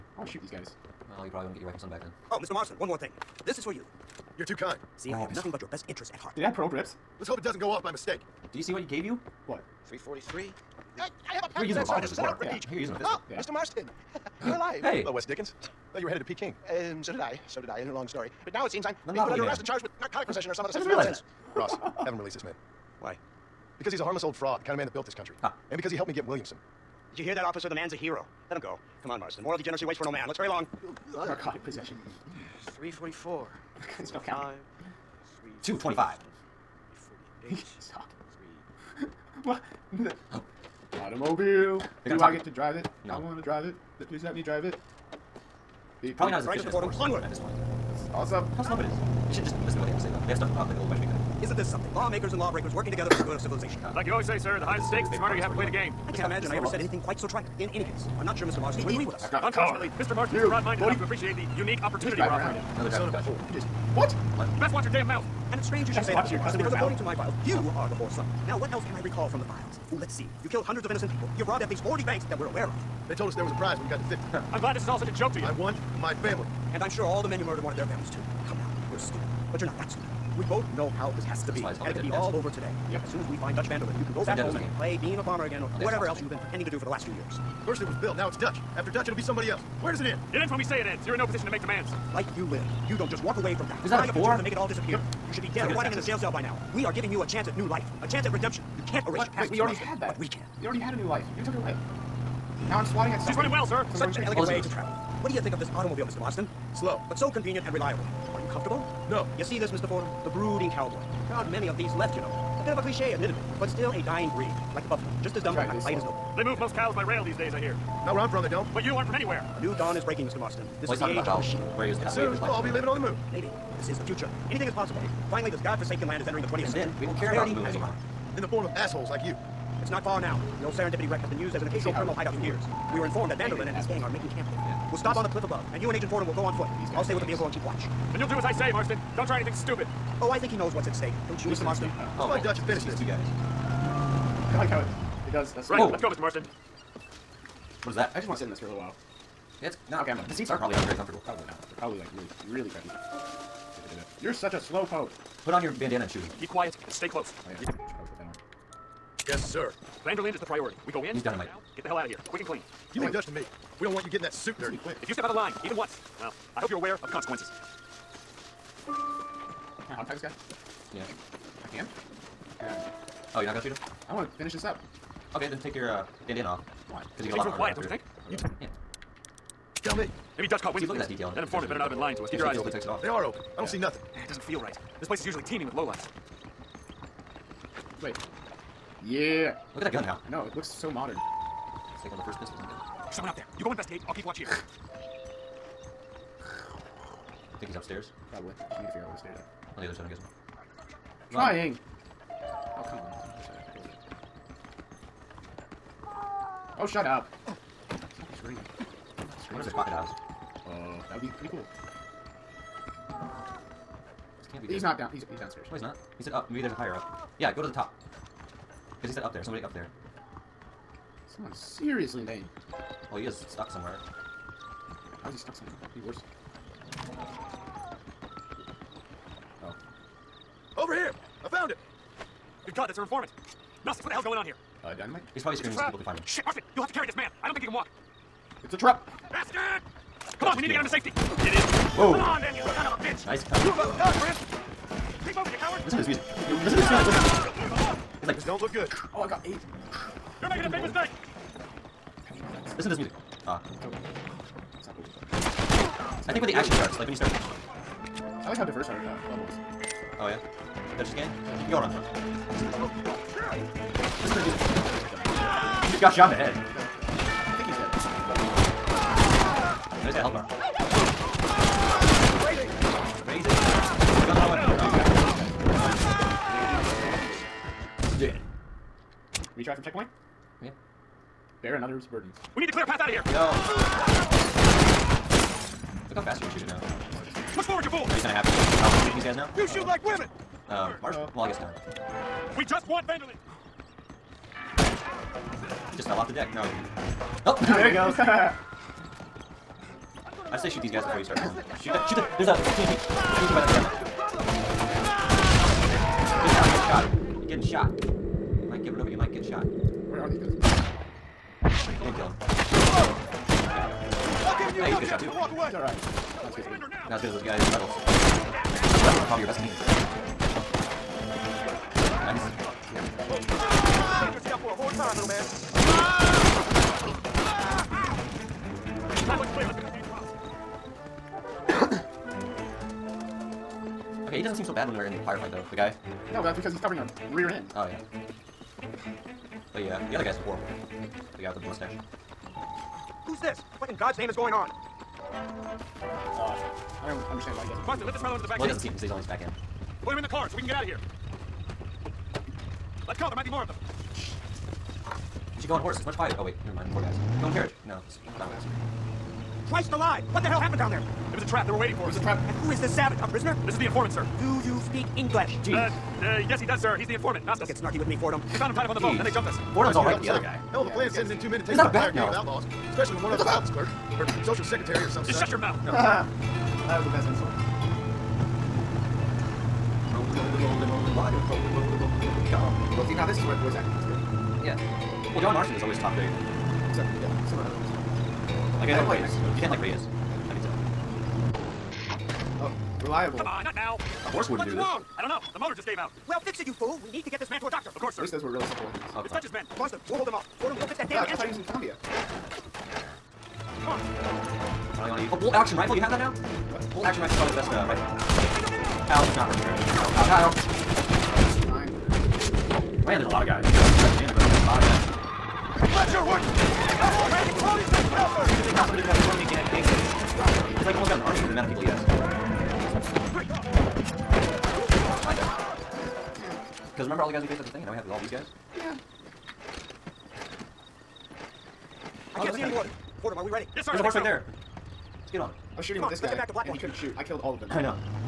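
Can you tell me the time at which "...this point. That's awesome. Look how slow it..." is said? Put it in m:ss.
0:47.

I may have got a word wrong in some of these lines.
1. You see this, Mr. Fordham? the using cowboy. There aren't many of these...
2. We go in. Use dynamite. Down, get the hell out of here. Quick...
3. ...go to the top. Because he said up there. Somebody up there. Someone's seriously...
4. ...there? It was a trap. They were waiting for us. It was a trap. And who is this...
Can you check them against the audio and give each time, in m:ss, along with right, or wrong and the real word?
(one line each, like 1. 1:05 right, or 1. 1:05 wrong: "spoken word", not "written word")
1. 1:49 wrong: "brooding", not "using"
2. 2:40 right
3. 3:37 right
4. 6:00 right.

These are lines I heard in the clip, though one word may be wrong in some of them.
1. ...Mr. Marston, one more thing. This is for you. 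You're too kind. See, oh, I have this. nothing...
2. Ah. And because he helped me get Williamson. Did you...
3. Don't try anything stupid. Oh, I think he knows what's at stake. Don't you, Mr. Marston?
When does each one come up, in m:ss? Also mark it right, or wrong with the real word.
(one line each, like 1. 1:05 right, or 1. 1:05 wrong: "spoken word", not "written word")
1. 0:02 right
2. 0:25 right
3. 2:19 right.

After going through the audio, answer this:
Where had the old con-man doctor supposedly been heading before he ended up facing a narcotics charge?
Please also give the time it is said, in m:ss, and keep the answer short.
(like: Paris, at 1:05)
Peking, at 0:16.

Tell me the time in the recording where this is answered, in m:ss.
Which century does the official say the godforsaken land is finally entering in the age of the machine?
2:06.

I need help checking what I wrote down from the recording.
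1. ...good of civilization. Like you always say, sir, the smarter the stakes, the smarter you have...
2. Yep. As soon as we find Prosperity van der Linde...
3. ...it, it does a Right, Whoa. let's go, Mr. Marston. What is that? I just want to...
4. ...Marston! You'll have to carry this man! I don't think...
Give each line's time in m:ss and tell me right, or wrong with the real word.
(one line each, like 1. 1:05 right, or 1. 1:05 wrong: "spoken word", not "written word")
1. 0:53 wrong: "higher", not "smarter"
2. 1:22 wrong: "Dutch", not "Prosperity"
3. 2:24 right
4. 3:56 right.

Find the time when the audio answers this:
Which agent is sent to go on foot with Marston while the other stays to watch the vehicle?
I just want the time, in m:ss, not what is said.
2:15.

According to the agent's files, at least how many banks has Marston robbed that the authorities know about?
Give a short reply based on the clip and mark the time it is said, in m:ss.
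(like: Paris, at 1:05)
40, at 1:11.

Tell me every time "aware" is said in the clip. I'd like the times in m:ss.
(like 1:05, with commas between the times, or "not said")
1:12, 2:46.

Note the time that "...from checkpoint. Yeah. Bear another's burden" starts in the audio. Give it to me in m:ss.
4:39.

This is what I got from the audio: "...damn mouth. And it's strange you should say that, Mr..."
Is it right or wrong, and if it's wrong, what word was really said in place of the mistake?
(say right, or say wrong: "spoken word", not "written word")
right.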